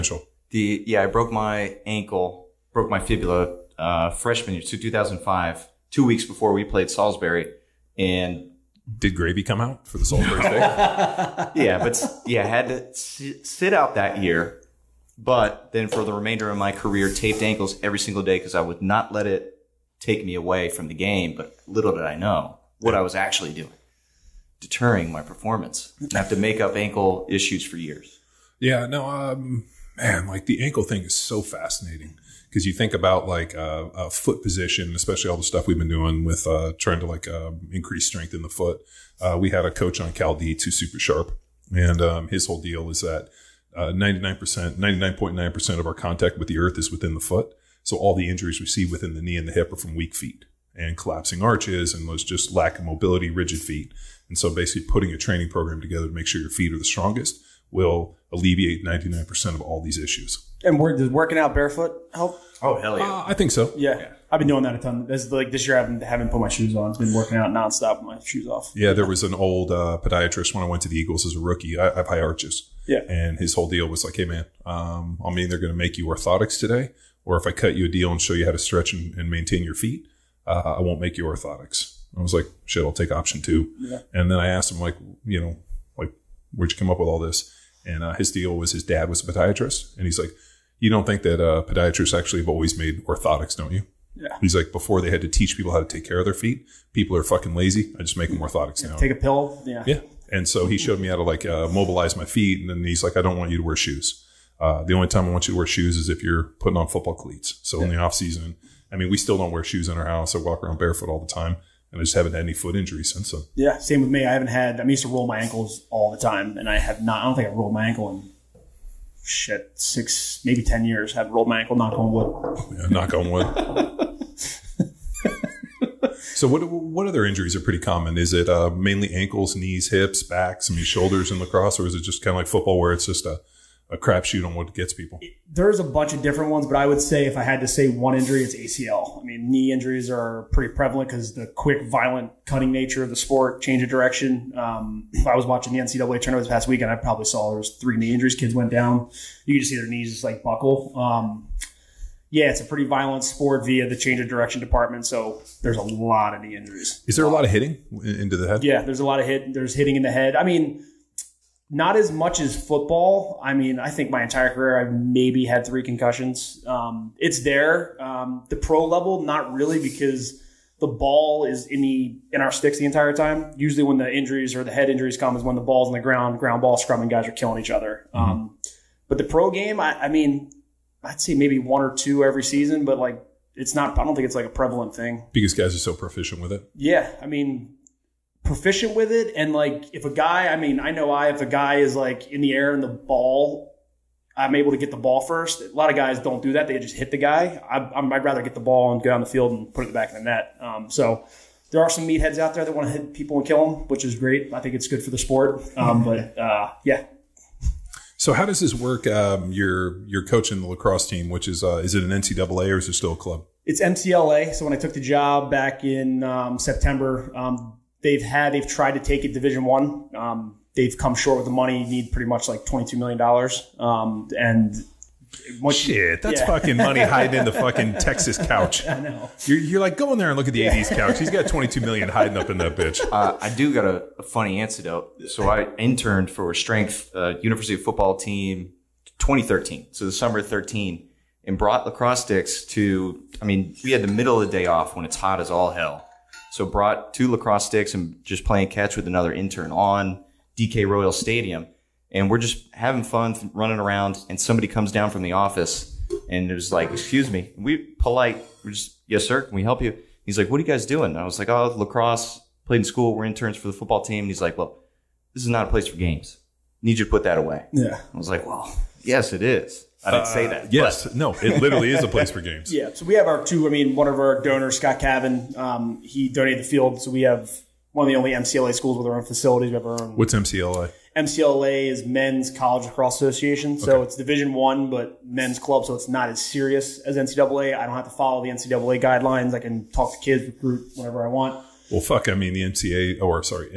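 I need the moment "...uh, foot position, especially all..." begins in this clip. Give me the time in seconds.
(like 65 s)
33 s.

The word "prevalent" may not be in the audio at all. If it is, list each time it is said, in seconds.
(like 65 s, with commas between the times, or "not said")
140 s, 184 s.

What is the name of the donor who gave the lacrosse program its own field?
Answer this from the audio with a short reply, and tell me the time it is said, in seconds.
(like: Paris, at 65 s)
Scott Cavan, at 274 s.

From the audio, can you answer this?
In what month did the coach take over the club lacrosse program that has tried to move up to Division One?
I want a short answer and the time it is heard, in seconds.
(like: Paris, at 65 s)
September, at 216 s.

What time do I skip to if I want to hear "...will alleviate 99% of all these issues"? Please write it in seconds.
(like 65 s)
57 s.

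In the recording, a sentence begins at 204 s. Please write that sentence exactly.
I think it's good for the sport.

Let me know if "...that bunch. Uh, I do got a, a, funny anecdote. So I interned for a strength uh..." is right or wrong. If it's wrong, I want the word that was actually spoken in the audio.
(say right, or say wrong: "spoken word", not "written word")
wrong: "bitch", not "bunch".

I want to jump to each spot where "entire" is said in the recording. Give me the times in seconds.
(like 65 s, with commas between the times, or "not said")
164 s, 172 s.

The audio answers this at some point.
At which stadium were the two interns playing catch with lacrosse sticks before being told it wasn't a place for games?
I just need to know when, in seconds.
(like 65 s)
250 s.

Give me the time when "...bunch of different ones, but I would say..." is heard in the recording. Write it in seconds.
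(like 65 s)
135 s.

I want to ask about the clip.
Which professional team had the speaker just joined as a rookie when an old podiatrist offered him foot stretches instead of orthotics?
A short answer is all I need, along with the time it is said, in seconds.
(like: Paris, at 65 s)
Eagles, at 70 s.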